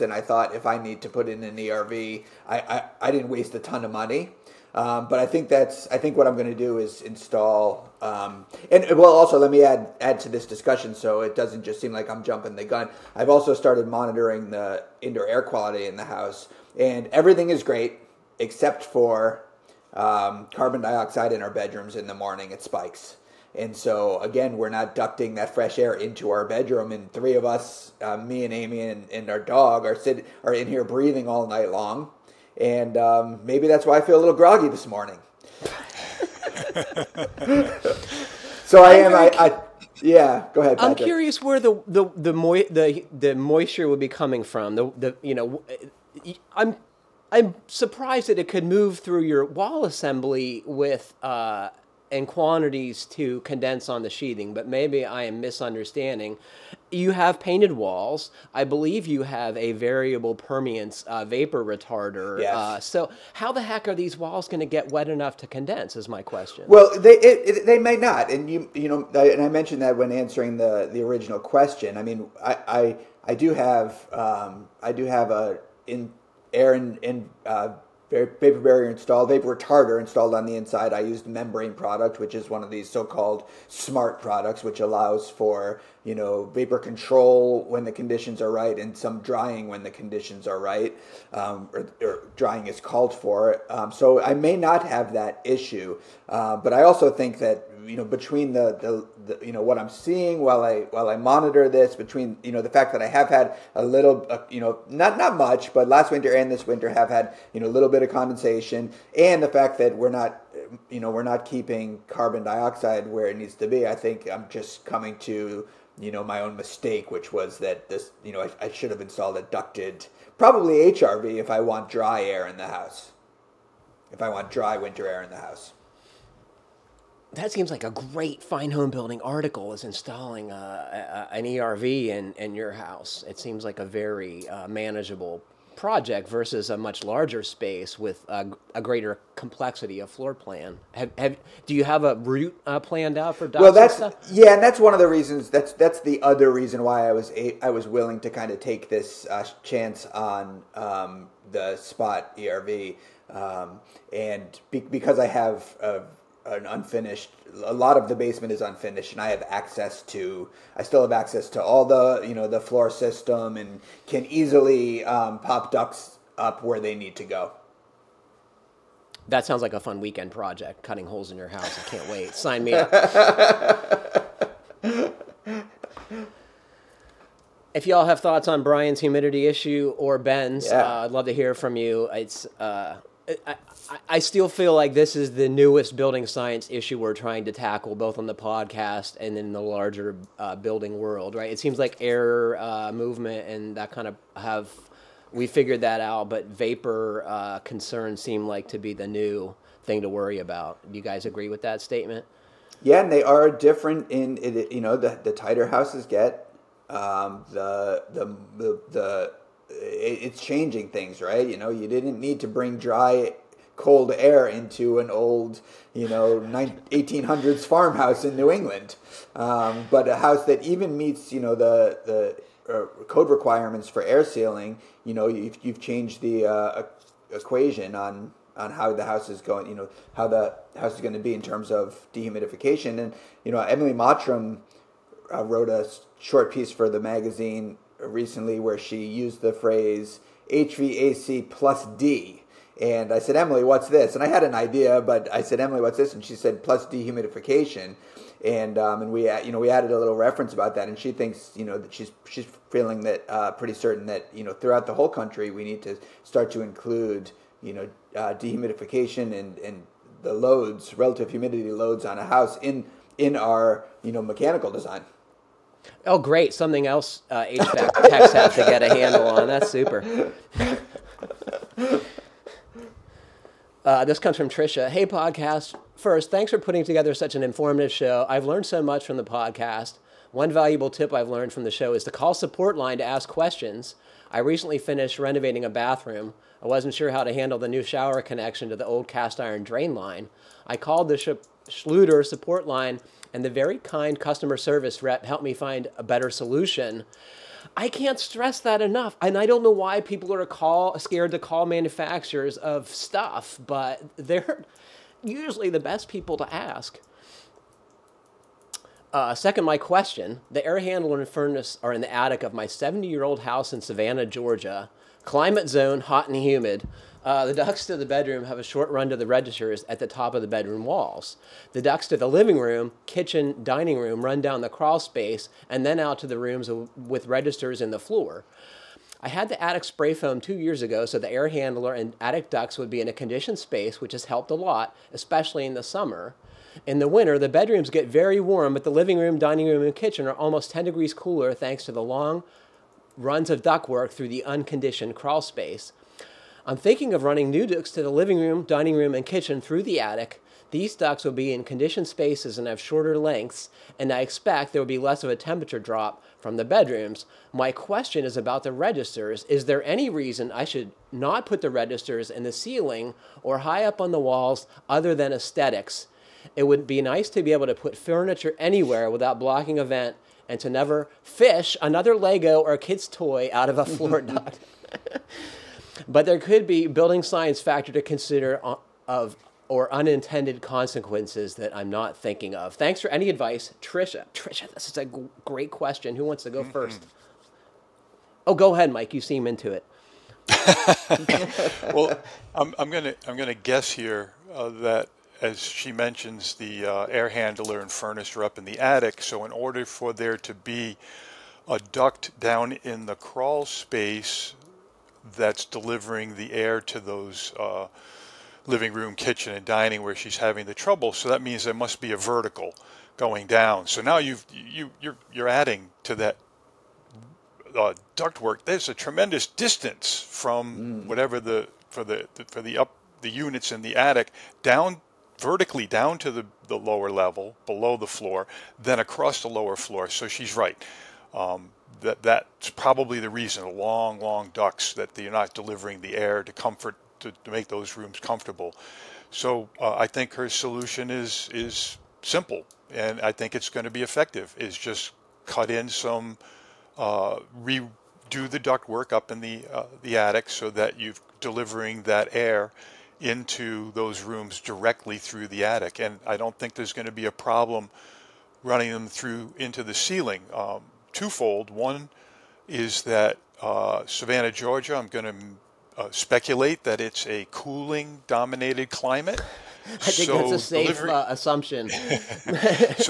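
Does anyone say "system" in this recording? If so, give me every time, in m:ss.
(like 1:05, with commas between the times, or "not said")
2:42.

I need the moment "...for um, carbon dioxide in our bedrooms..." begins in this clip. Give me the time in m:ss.
0:18.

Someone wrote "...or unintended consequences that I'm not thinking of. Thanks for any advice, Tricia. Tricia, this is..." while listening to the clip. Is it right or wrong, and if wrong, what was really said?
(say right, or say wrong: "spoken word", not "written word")
right.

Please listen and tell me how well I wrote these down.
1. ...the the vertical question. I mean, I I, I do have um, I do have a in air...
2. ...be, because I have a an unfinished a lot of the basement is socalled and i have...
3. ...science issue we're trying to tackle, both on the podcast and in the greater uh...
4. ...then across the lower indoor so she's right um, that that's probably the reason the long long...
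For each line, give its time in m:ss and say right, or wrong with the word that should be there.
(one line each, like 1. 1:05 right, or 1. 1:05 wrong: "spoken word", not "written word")
1. 1:10 wrong: "original", not "vertical"
2. 2:34 wrong: "unfinished", not "socalled"
3. 3:06 wrong: "larger", not "greater"
4. 7:08 wrong: "floor", not "indoor".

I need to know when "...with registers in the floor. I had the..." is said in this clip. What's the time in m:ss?
5:26.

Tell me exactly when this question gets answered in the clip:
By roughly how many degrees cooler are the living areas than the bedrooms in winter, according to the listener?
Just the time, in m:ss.
5:40.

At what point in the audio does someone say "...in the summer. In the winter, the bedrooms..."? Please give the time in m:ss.
5:35.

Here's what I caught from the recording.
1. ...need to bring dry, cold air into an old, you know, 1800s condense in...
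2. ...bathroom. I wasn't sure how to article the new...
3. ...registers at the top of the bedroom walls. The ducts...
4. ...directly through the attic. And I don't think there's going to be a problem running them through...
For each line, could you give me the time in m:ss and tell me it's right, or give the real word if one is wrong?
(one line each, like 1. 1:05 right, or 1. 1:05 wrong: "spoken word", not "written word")
1. 3:32 wrong: "farmhouse", not "condense"
2. 4:45 wrong: "handle", not "article"
3. 5:19 right
4. 7:34 right.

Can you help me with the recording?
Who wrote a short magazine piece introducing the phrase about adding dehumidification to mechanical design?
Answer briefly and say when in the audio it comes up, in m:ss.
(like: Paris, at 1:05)
Emily Mottram, at 3:53.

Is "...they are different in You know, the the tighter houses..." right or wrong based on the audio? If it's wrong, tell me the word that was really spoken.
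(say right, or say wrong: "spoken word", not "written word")
right.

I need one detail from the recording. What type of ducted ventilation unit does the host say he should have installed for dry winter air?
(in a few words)
HRV.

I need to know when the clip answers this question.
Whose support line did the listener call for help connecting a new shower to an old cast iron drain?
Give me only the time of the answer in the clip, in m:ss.
4:51.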